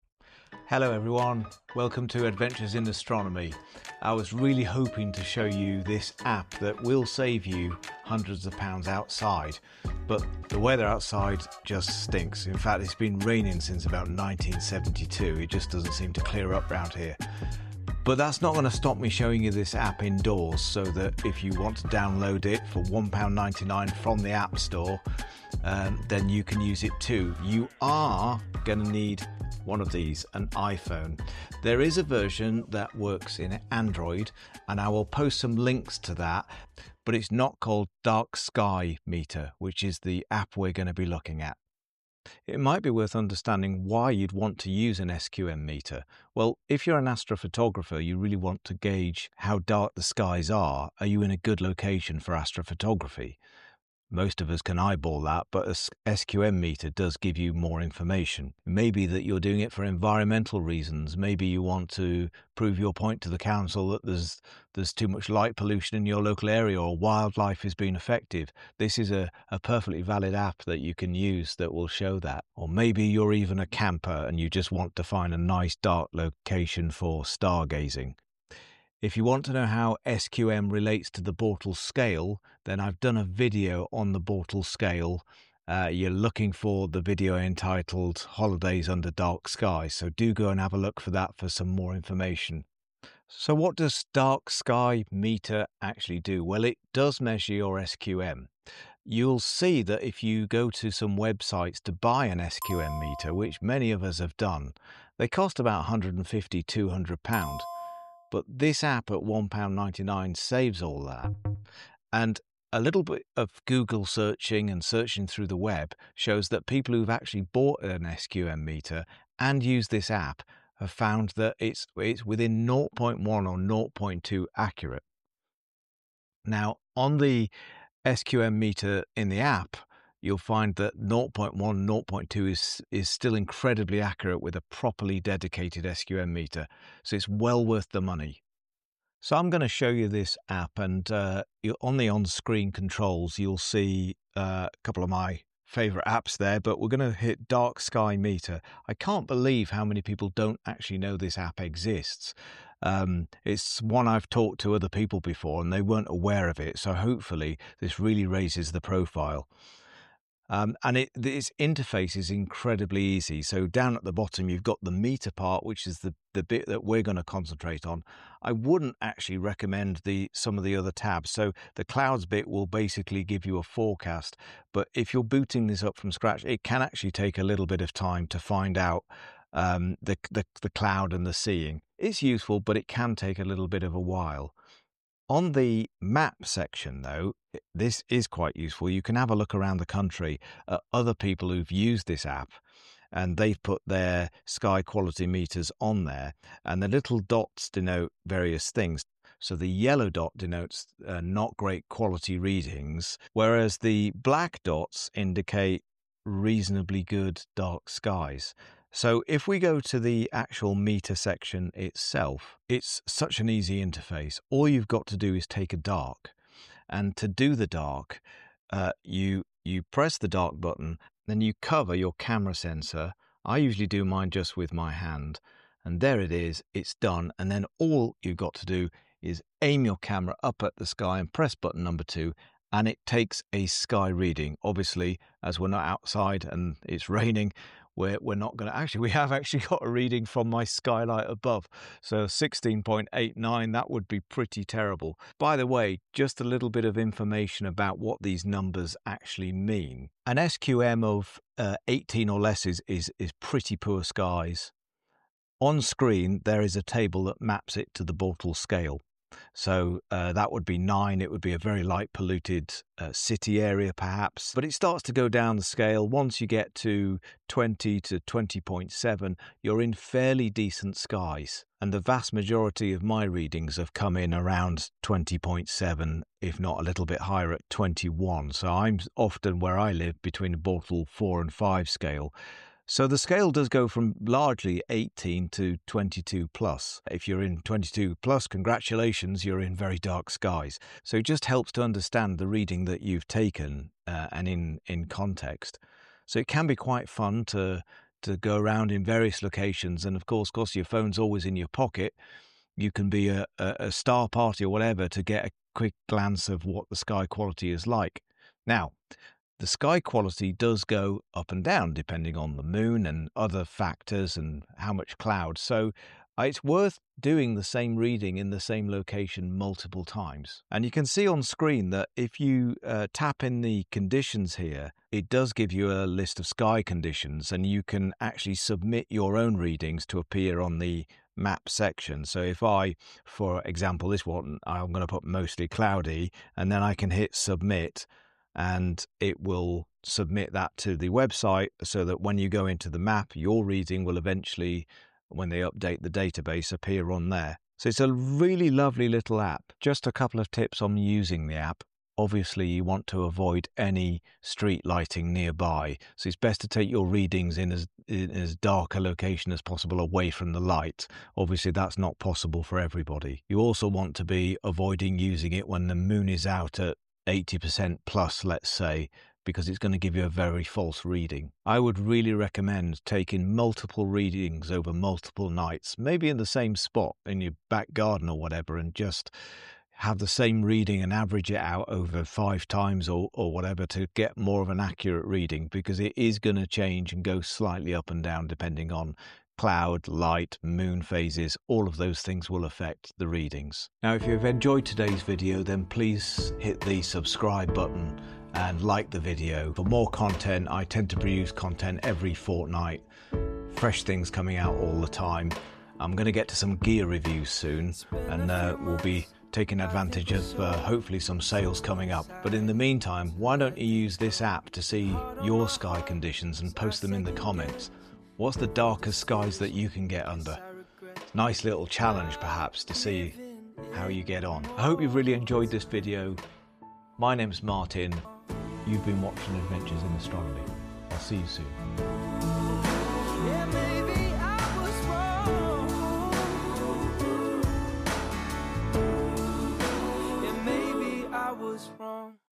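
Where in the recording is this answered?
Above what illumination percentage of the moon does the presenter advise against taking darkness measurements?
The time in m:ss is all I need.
6:07.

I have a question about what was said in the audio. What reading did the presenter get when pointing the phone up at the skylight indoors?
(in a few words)
16.89.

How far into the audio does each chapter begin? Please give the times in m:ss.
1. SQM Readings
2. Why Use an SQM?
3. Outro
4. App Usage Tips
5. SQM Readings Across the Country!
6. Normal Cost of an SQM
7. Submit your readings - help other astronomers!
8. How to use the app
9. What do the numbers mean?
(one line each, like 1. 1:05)
1. 1:19
2. 0:42
3. 6:33
4. 5:50
5. 3:05
6. 1:39
7. 5:20
8. 2:19
9. 4:05.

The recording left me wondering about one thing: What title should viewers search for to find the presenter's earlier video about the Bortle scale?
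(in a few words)
Holidays Under Dark Skies.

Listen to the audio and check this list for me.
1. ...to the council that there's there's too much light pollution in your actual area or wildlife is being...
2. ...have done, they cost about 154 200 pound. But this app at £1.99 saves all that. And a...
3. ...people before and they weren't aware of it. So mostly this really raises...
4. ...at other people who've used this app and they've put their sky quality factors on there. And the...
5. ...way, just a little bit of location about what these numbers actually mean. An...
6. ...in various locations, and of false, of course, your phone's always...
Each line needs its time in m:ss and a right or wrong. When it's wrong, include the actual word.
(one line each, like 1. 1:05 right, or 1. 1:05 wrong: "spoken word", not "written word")
1. 1:03 wrong: "local", not "actual"
2. 1:44 wrong: "150", not "154"
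3. 2:34 wrong: "hopefully", not "mostly"
4. 3:10 wrong: "meters", not "factors"
5. 4:05 wrong: "information", not "location"
6. 4:58 wrong: "course", not "false".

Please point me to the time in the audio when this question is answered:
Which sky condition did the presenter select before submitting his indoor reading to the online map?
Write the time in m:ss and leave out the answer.
5:35.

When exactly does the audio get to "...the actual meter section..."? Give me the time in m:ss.
3:30.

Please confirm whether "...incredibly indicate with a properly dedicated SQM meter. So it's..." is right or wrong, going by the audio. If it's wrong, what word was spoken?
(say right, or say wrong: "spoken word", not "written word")
wrong: "accurate", not "indicate".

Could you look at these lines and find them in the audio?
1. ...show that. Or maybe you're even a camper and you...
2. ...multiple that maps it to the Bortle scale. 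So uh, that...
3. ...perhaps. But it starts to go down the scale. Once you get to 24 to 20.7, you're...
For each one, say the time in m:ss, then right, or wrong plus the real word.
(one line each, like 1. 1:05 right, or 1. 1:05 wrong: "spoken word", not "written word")
1. 1:11 right
2. 4:16 wrong: "table", not "multiple"
3. 4:23 wrong: "20", not "24".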